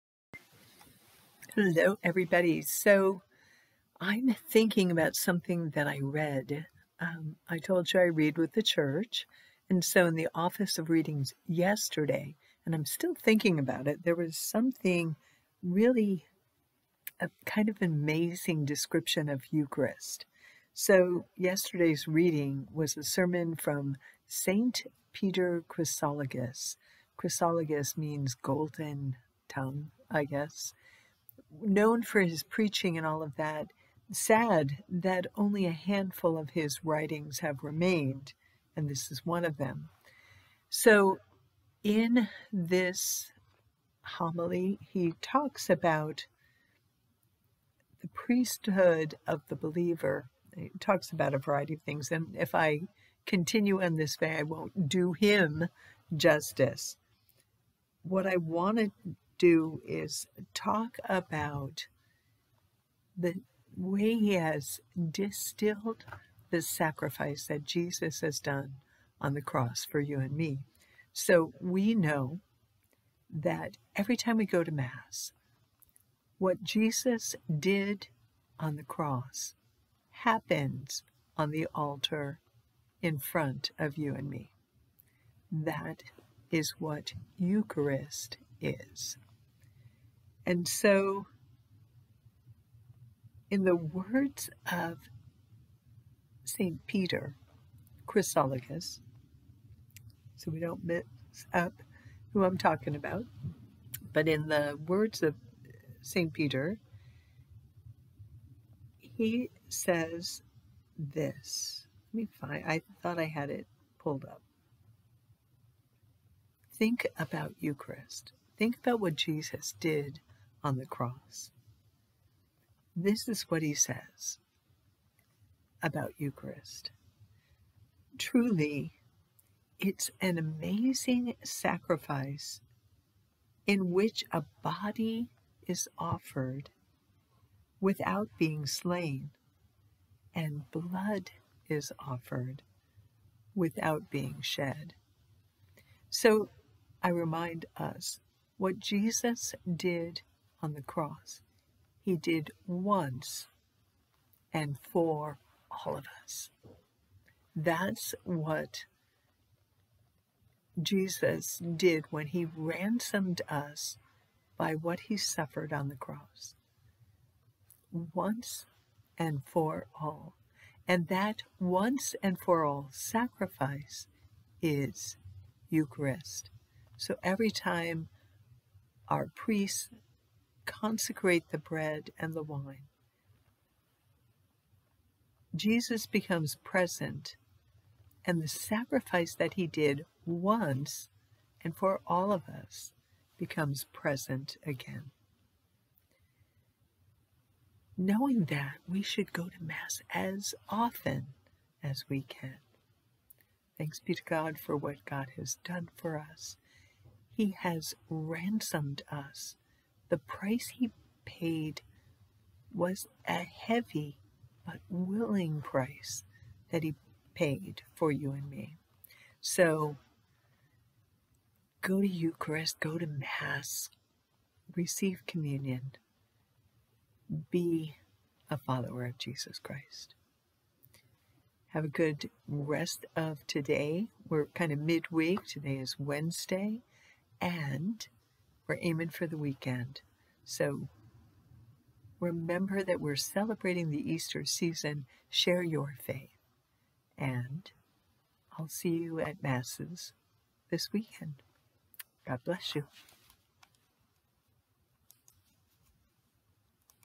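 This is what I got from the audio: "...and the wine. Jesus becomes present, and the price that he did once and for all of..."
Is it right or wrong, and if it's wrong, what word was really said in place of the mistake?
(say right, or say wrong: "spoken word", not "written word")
wrong: "sacrifice", not "price".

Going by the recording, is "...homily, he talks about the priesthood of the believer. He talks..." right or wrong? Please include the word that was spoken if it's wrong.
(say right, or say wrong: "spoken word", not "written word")
right.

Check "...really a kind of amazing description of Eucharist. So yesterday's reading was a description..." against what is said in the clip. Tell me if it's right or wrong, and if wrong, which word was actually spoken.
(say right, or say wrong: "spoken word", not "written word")
wrong: "sermon", not "description".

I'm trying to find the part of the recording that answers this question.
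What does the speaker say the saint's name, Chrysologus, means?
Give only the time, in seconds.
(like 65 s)
28 s.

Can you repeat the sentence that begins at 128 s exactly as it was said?
Truly, it's an amazing sacrifice in which a body is offered without being slain, and blood is offered without being shed.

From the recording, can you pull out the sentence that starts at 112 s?
Let me find, I thought I had it pulled up.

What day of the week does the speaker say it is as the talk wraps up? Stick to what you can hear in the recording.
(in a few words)
Wednesday.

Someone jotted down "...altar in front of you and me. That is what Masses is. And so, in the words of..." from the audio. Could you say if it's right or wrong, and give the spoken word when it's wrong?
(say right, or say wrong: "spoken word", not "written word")
wrong: "Eucharist", not "Masses".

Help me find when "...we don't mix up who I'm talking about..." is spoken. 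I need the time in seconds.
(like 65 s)
100 s.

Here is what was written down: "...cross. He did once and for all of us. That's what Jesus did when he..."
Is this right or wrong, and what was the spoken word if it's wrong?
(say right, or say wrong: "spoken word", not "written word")
right.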